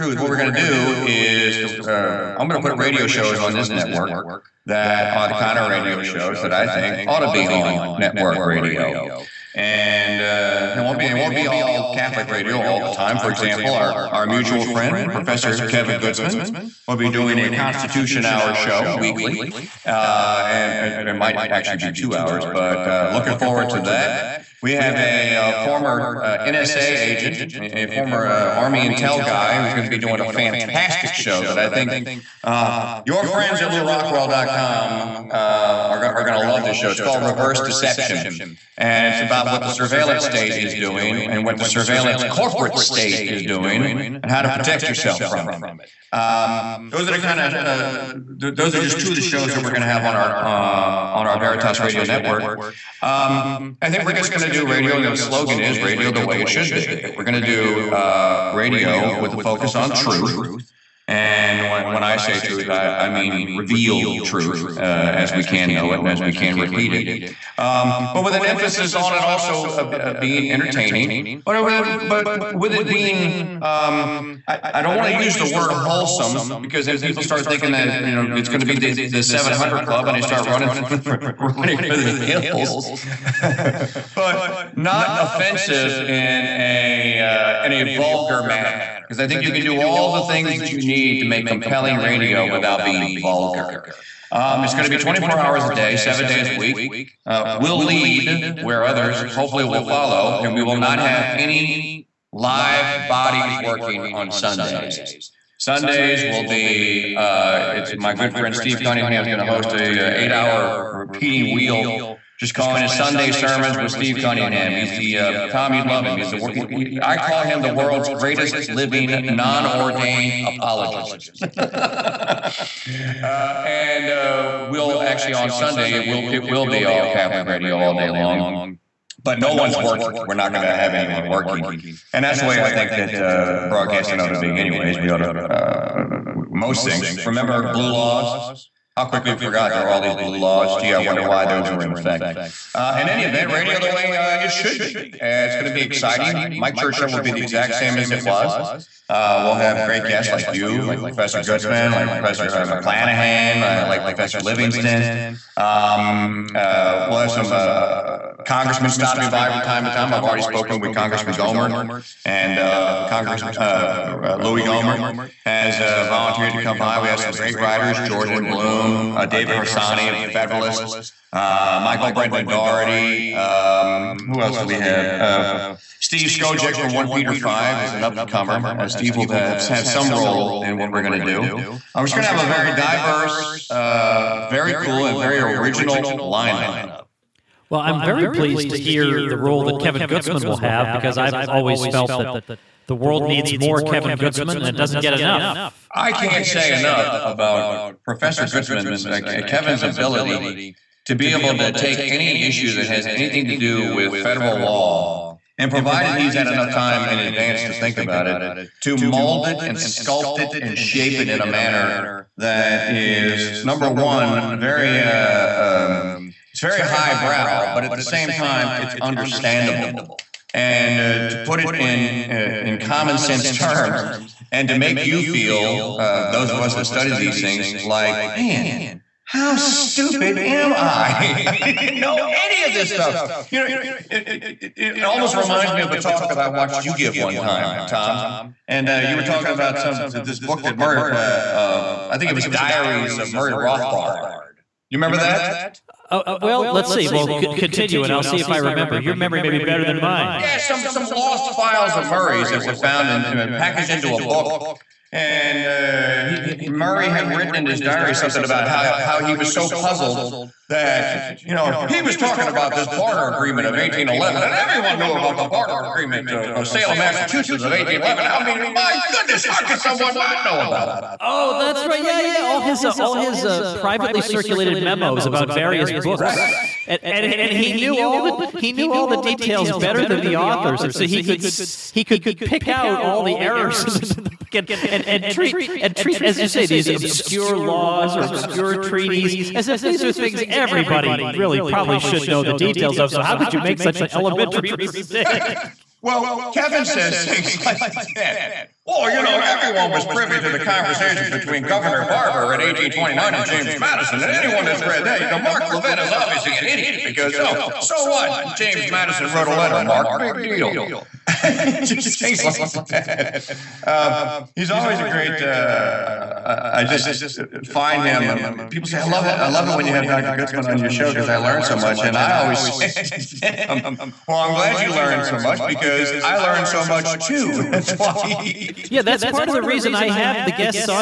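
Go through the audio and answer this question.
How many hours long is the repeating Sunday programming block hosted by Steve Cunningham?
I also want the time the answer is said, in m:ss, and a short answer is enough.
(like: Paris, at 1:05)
8, at 1:50.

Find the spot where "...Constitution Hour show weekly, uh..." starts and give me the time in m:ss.
0:17.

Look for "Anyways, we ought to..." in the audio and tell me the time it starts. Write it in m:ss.
2:14.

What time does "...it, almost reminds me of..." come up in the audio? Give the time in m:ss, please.
3:54.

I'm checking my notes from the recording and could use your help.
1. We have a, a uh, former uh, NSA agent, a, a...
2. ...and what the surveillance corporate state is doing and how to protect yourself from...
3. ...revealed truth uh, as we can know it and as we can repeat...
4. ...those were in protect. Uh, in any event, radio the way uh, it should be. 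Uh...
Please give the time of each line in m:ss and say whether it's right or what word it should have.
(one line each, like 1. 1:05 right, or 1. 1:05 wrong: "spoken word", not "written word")
1. 0:24 right
2. 0:41 right
3. 1:03 right
4. 2:21 wrong: "effect", not "protect".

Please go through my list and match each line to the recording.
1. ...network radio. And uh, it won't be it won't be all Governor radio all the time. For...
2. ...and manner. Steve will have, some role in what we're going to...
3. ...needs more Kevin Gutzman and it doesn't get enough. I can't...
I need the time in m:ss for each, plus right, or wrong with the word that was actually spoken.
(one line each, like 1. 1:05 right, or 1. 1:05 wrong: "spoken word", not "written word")
1. 0:07 wrong: "Catholic", not "Governor"
2. 2:58 wrong: "comer", not "manner"
3. 3:13 right.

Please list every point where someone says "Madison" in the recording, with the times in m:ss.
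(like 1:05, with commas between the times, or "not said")
5:03, 5:08.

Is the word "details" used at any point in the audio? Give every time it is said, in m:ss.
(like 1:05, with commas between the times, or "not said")
4:39, 4:52.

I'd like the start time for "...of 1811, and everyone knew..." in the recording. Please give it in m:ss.
4:23.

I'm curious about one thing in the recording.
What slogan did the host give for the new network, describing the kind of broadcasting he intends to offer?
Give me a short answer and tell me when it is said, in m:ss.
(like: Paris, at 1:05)
Radio the way it should be, at 0:55.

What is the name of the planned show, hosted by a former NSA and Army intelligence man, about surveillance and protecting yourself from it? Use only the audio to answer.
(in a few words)
Reverse Deception.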